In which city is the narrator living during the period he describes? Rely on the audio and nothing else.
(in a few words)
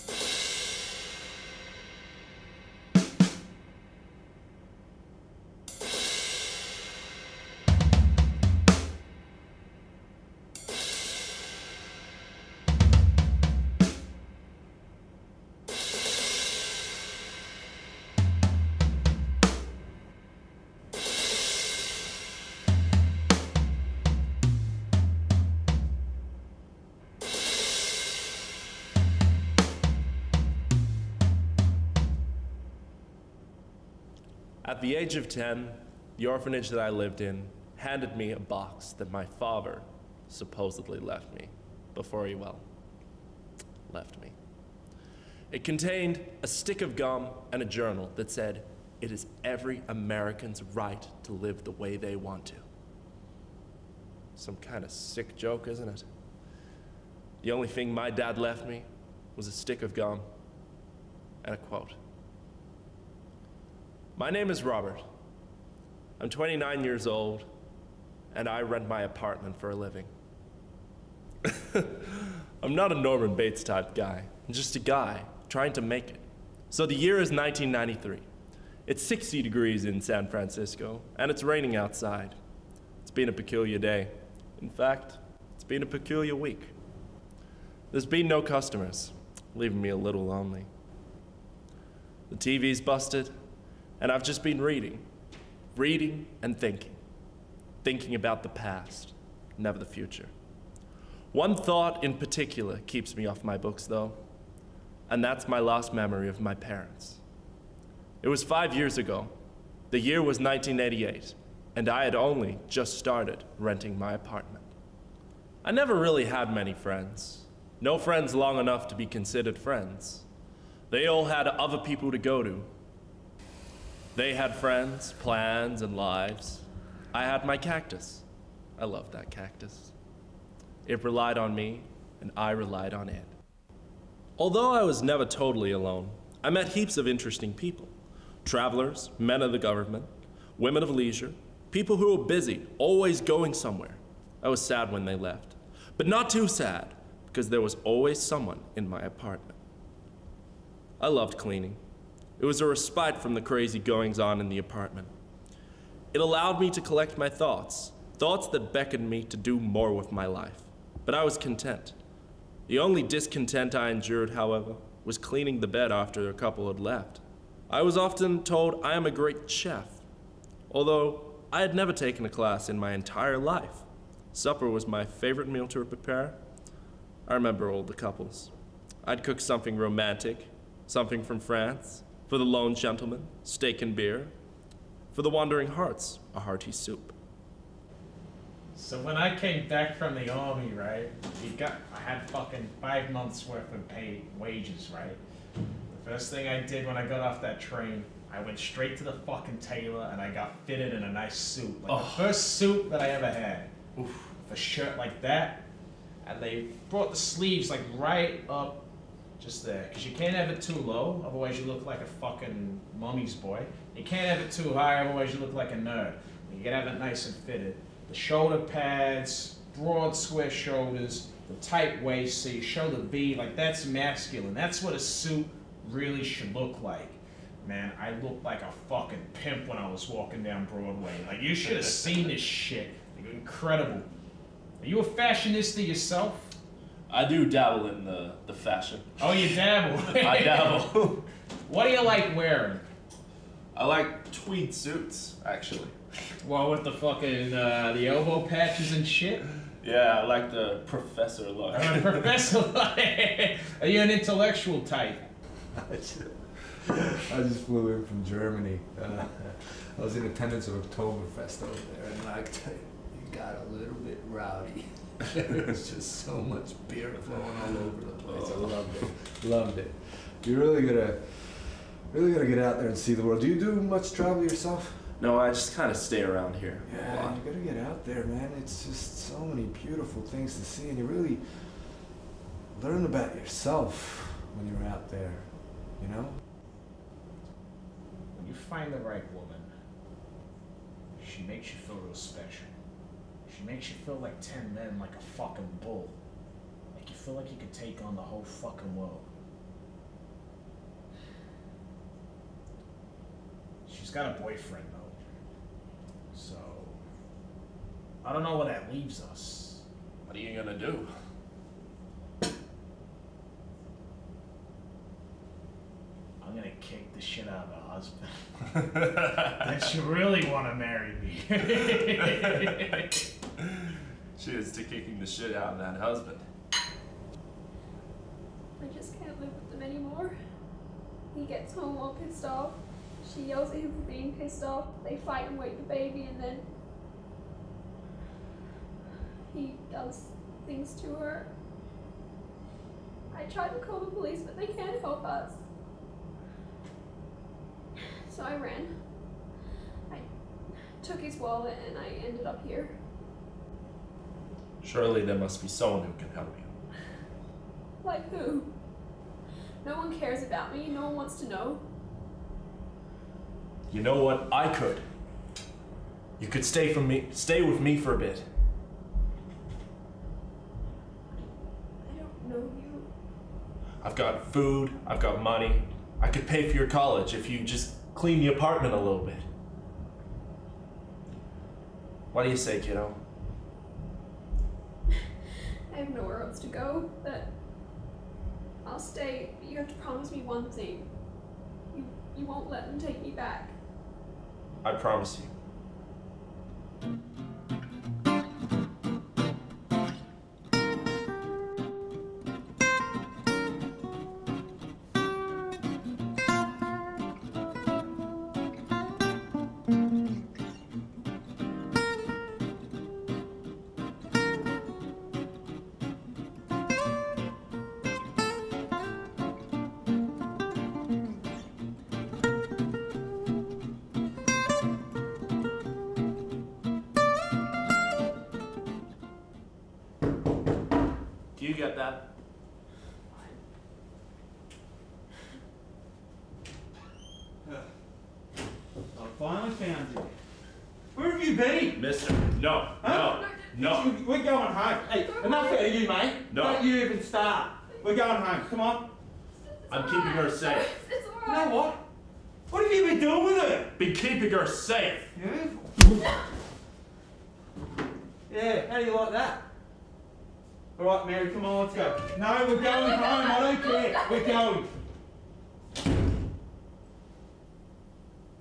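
San Francisco.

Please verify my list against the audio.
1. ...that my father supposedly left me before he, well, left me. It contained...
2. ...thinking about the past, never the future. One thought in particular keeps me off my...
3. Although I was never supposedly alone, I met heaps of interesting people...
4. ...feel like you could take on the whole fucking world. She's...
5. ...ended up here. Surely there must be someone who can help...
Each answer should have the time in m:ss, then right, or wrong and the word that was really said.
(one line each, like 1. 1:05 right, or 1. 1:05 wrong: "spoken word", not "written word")
1. 0:38 right
2. 1:37 right
3. 2:14 wrong: "totally", not "supposedly"
4. 4:57 right
5. 5:52 right.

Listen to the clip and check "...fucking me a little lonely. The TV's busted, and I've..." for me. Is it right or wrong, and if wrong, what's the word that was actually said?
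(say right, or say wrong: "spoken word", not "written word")
wrong: "leaving", not "fucking".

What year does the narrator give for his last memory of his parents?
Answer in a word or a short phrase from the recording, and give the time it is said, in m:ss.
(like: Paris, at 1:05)
1988, at 1:50.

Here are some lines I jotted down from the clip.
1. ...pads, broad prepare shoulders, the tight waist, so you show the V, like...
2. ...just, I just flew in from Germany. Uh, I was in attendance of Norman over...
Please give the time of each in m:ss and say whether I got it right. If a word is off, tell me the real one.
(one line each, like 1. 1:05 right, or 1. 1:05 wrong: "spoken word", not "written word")
1. 3:38 wrong: "square", not "prepare"
2. 4:15 wrong: "Oktoberfest", not "Norman".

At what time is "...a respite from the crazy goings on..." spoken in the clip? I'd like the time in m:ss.
2:32.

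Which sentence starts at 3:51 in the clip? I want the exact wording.
Like you should have seen this shit.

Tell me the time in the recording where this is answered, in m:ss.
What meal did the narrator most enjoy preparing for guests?
2:54.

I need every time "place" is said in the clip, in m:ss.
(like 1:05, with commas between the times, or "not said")
4:28.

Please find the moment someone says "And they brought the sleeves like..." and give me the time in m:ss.
3:26.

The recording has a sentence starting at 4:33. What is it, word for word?
Do you do much travel yourself?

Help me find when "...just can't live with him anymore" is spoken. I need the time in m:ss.
5:28.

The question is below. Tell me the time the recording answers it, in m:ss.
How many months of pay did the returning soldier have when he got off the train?
3:12.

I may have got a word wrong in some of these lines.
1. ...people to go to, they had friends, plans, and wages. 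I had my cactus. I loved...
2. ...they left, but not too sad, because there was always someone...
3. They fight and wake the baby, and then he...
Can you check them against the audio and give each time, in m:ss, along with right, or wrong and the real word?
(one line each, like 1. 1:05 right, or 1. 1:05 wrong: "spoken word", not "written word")
1. 2:01 wrong: "lives", not "wages"
2. 2:25 right
3. 5:35 right.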